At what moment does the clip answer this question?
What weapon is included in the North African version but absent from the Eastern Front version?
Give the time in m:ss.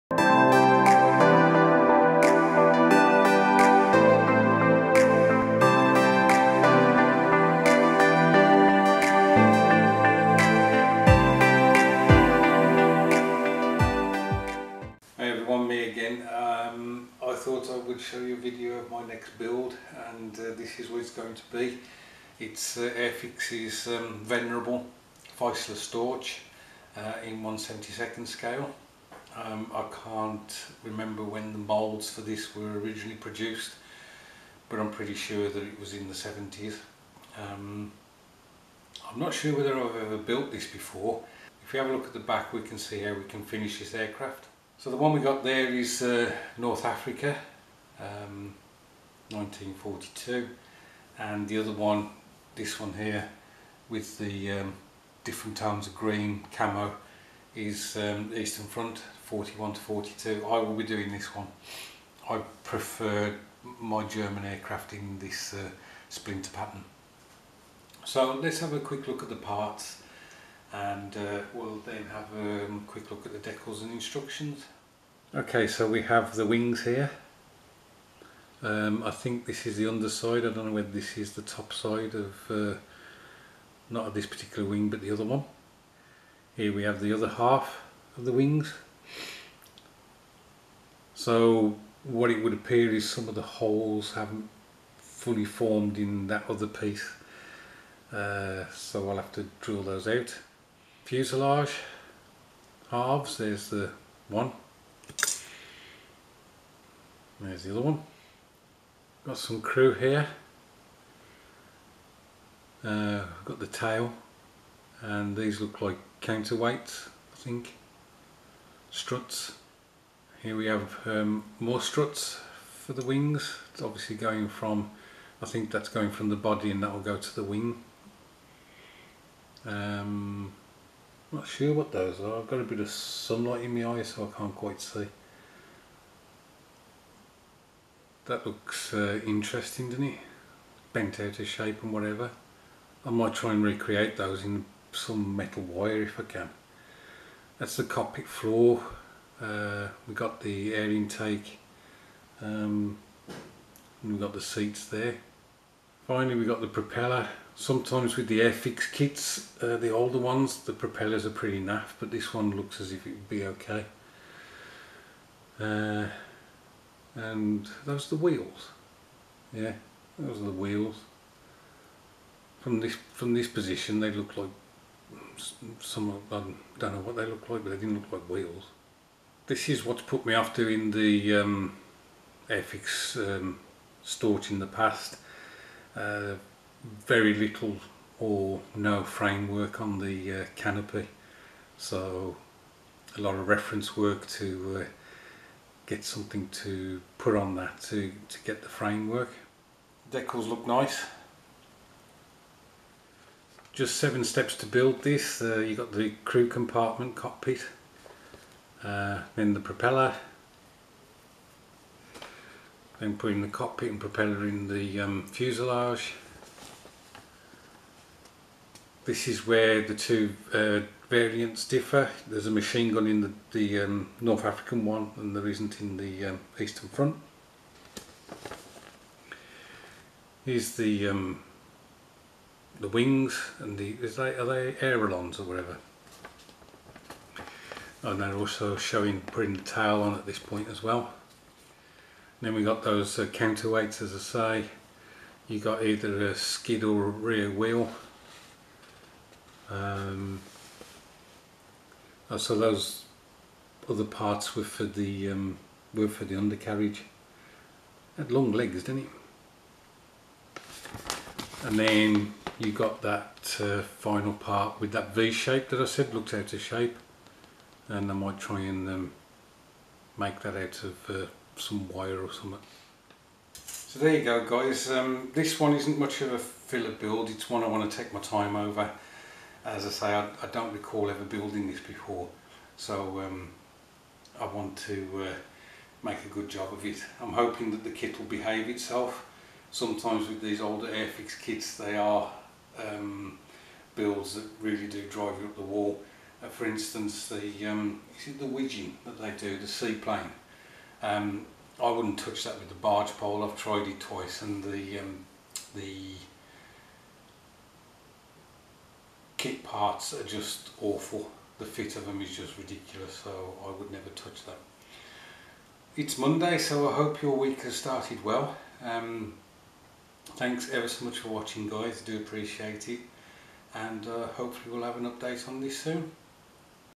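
3:42.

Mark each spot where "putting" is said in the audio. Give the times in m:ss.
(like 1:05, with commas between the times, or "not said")
3:33, 3:59.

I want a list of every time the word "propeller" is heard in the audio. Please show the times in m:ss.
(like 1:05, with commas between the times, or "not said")
2:36, 2:40, 3:29, 3:33.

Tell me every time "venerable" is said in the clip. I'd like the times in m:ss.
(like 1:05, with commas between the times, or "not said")
0:24.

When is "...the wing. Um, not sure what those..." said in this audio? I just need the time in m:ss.
2:07.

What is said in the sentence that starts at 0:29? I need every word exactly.
Um, I can't remember when the moulds for this were originally produced but I'm pretty sure that it was in the 70s.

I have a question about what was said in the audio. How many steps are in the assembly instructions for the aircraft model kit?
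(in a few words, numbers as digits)
7.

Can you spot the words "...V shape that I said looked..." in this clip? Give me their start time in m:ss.
4:25.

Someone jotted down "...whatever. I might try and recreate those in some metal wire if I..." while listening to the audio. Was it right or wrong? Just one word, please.
right.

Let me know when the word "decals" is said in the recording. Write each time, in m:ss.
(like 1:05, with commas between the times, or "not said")
1:13, 3:20.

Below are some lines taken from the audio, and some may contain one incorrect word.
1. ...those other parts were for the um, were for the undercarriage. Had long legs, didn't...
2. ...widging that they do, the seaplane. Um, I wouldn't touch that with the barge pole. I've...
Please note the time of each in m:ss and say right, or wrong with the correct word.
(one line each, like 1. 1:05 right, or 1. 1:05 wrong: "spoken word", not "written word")
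1. 4:12 right
2. 4:58 right.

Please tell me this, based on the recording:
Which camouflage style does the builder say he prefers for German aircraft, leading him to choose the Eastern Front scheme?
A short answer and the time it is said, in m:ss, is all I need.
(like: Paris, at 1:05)
Splinter pattern, at 1:06.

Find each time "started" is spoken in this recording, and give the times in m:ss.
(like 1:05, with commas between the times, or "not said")
5:17.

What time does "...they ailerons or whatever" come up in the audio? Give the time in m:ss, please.
3:54.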